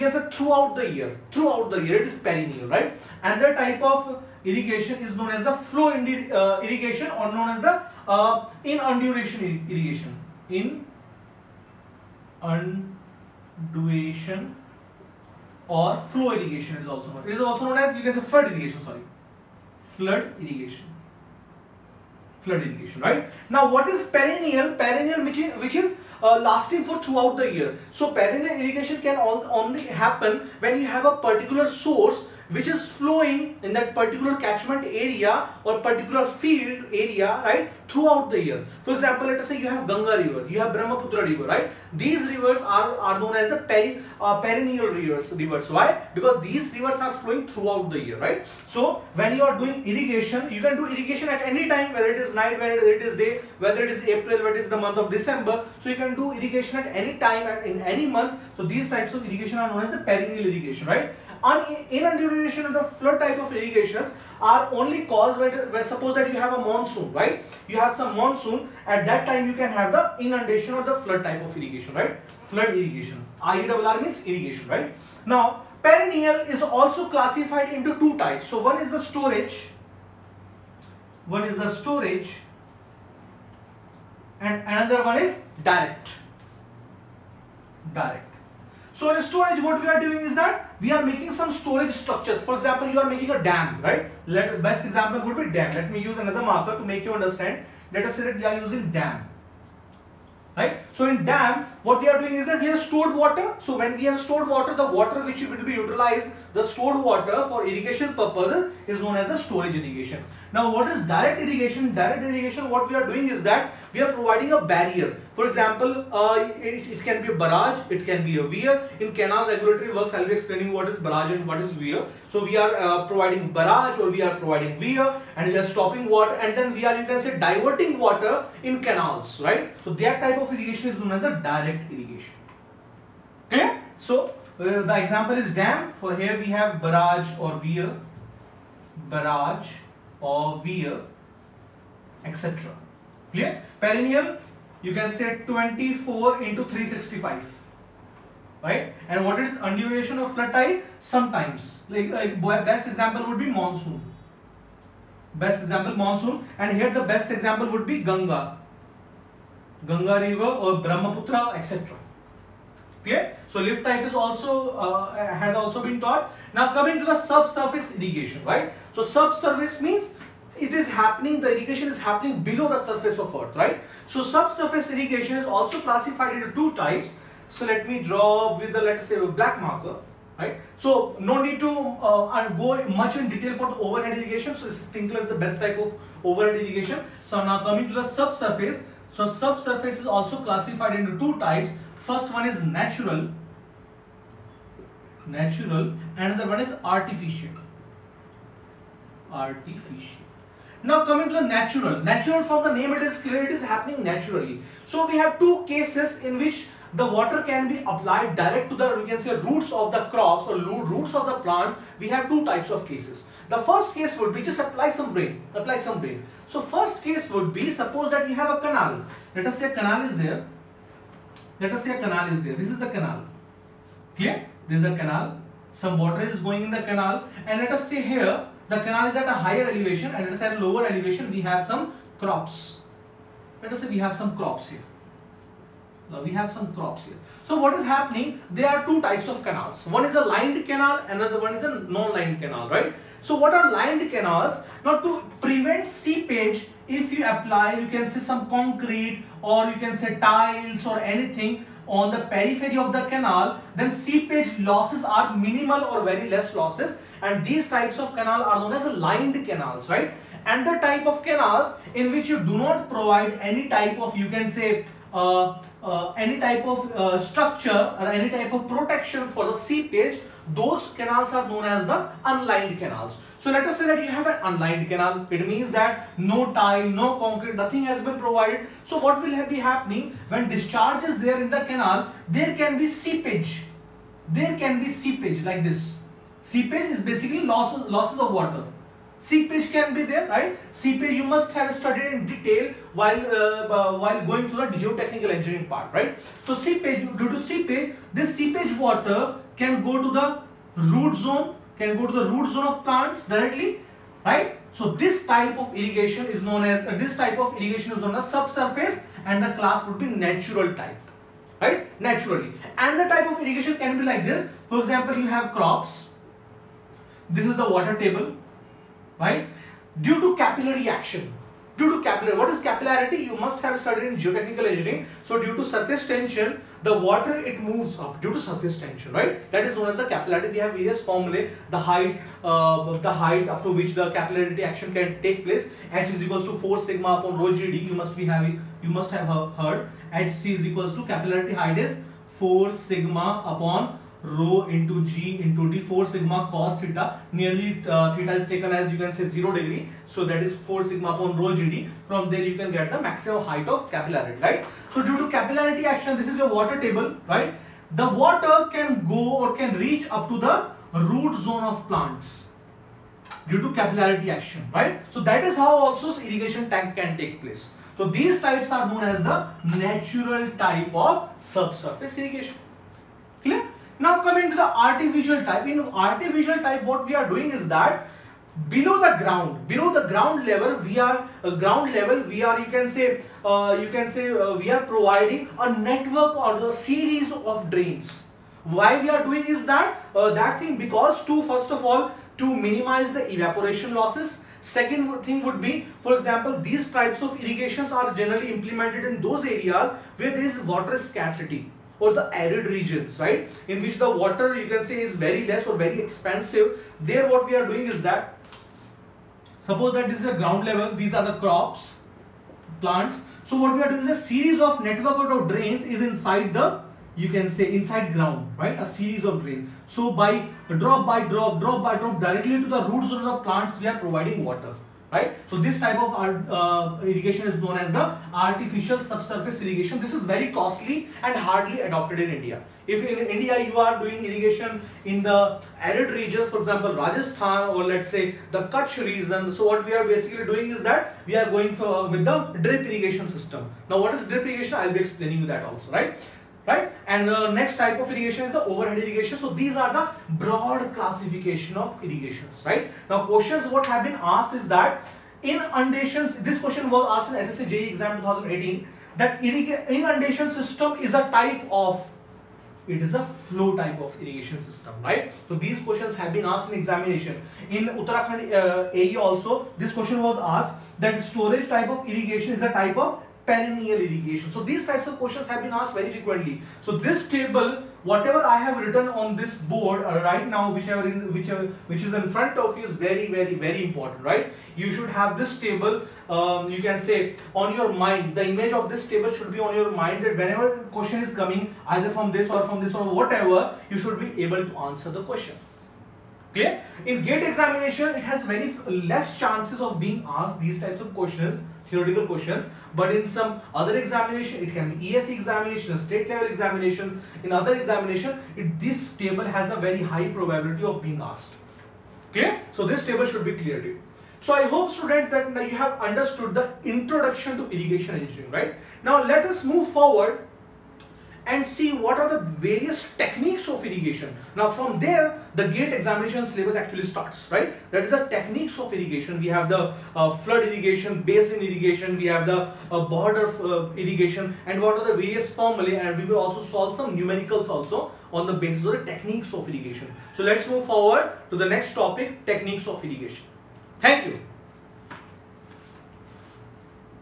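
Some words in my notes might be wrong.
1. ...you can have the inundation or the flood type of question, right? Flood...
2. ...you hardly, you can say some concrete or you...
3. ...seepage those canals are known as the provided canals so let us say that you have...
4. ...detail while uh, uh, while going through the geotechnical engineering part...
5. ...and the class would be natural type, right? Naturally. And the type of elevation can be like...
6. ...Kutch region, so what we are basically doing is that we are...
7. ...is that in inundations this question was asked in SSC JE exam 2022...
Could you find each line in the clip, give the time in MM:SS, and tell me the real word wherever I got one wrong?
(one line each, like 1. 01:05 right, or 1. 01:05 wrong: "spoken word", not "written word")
1. 01:09 wrong: "irrigation", not "question"
2. 04:07 wrong: "apply", not "hardly"
3. 04:29 wrong: "unlined", not "provided"
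4. 04:52 right
5. 05:09 wrong: "irrigation", not "elevation"
6. 07:18 right
7. 07:34 wrong: "2018", not "2022".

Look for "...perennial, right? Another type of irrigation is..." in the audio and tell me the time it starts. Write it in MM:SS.
00:02.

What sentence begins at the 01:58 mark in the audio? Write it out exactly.
In canal regulatory works, I'll be explaining what is barrage and what is weir.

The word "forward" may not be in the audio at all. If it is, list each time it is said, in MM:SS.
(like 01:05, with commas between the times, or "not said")
08:39, 09:00.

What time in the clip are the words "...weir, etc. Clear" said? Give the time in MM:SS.
02:20.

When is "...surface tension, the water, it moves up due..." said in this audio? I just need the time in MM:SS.
05:25.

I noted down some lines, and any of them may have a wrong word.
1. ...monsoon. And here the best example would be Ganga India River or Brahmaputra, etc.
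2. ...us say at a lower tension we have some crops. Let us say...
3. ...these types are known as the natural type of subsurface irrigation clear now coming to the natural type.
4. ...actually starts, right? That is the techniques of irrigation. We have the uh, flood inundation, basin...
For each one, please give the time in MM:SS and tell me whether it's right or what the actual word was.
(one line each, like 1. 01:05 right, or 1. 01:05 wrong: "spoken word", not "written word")
1. 02:35 wrong: "Ganga", not "India"
2. 03:50 wrong: "elevation", not "tension"
3. 06:08 wrong: "artificial", not "natural"
4. 08:46 wrong: "irrigation", not "inundation".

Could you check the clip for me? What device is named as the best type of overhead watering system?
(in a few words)
Sprinkler.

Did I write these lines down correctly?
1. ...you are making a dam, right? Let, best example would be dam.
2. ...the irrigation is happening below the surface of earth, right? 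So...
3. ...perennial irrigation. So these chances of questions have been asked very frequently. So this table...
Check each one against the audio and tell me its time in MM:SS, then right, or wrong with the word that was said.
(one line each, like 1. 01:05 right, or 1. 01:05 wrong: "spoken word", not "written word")
1. 01:32 right
2. 02:51 right
3. 07:53 wrong: "types", not "chances".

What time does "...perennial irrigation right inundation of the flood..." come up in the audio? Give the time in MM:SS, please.
00:59.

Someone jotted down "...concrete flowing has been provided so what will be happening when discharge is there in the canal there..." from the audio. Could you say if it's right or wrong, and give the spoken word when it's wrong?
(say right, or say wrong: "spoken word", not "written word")
wrong: "nothing", not "flowing".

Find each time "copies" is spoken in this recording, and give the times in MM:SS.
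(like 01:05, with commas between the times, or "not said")
not said.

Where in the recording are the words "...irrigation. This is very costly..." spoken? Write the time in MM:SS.
07:09.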